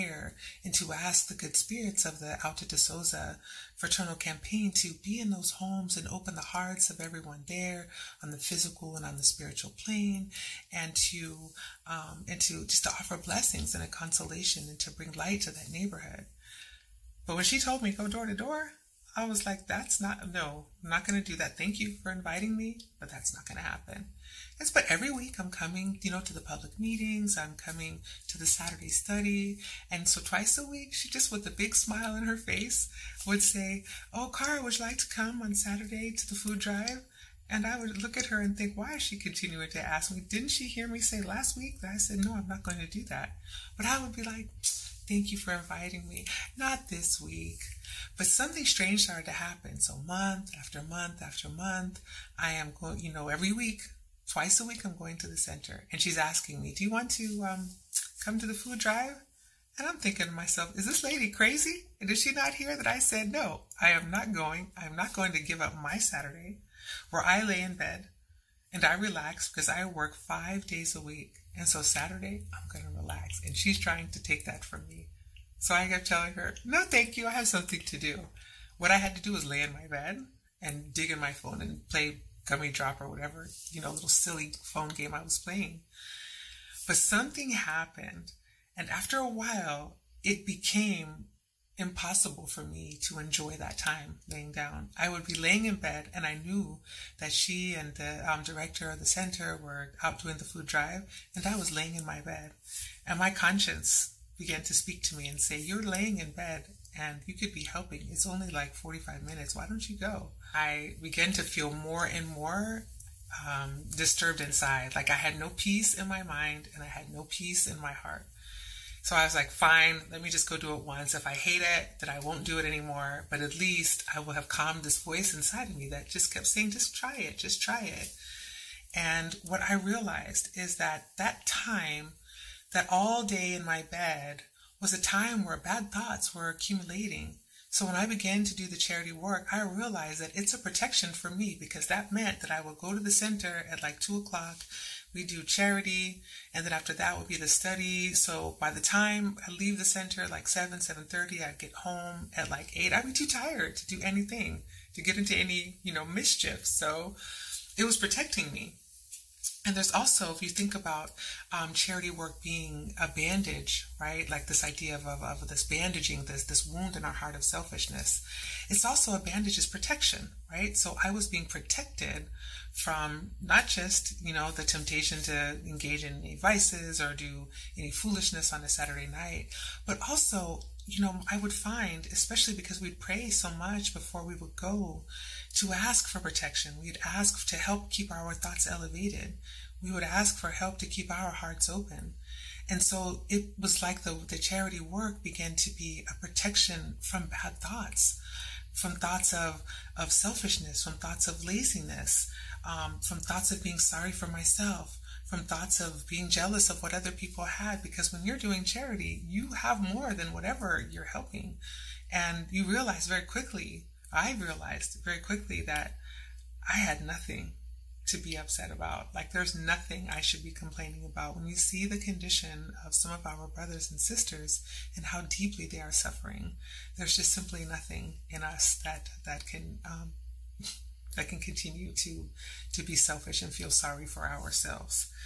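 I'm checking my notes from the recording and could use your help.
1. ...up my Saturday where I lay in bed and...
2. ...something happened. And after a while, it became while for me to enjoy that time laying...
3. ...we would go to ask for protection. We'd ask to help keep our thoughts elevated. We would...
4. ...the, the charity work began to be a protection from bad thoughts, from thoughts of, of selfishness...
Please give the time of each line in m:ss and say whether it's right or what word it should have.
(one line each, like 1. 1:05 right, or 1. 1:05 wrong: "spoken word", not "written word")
1. 1:05 right
2. 1:26 wrong: "impossible", not "while"
3. 3:04 right
4. 3:14 right.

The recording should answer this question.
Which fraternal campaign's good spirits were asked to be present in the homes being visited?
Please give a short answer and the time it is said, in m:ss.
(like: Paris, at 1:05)
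Auta de Souza, at 0:02.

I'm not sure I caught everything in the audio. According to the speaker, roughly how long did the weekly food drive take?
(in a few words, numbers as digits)
45 minutes.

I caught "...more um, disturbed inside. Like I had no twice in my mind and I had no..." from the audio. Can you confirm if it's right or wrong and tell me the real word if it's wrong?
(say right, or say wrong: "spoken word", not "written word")
wrong: "peace", not "twice".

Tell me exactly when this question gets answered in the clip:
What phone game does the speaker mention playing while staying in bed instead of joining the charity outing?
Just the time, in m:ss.
1:22.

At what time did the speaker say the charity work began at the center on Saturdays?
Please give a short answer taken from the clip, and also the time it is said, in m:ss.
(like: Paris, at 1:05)
2 o'clock, at 2:23.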